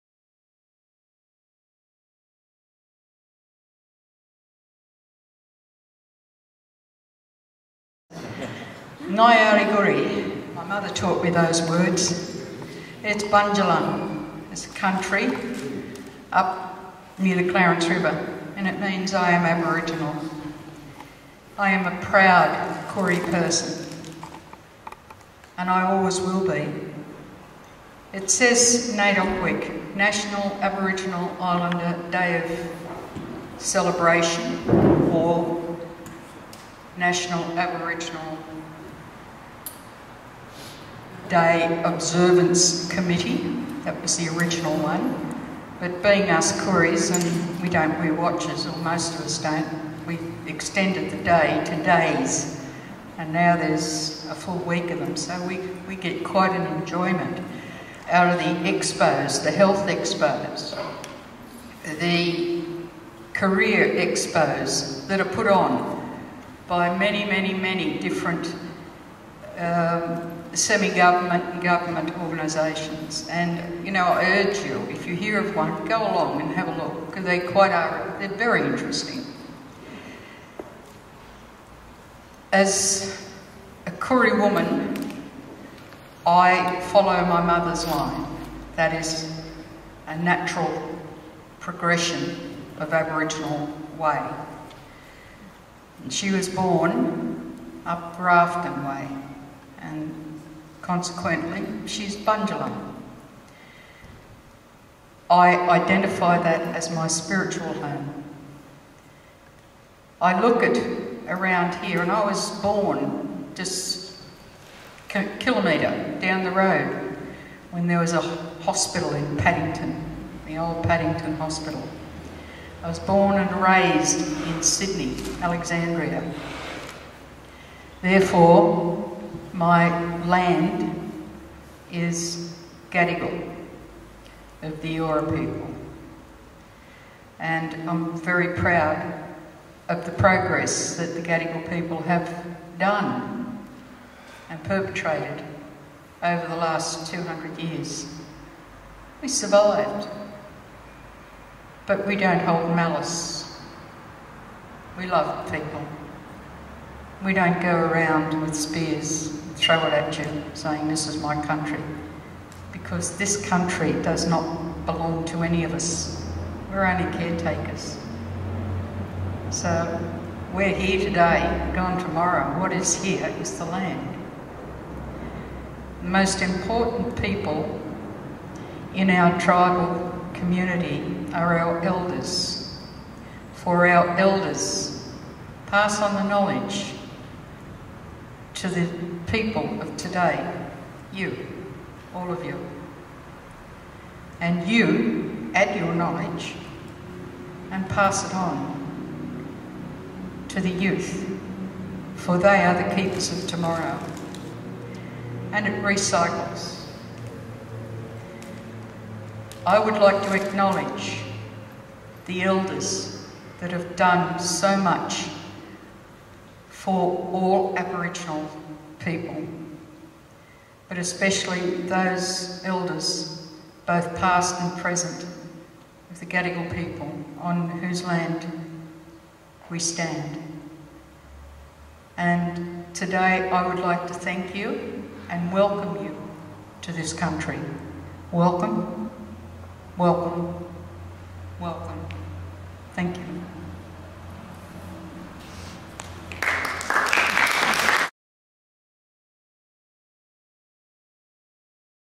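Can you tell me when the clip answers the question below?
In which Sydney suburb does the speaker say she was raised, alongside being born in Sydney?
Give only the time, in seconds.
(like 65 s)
125 s.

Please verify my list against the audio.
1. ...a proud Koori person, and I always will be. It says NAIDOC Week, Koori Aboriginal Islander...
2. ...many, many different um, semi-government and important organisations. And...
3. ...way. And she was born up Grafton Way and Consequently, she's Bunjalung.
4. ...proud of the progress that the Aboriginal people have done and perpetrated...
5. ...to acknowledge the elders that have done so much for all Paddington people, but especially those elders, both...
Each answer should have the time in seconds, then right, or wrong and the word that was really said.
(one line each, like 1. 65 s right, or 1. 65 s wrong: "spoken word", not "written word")
1. 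21 s wrong: "National", not "Koori"
2. 67 s wrong: "government", not "important"
3. 93 s right
4. 138 s wrong: "Gadigal", not "Aboriginal"
5. 210 s wrong: "Aboriginal", not "Paddington".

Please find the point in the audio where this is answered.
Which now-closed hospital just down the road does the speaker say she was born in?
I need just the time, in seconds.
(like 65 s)
120 s.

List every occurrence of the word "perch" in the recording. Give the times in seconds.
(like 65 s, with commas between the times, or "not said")
not said.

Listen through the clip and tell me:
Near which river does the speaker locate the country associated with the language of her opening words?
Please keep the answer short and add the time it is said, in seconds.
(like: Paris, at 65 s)
Clarence River, at 17 s.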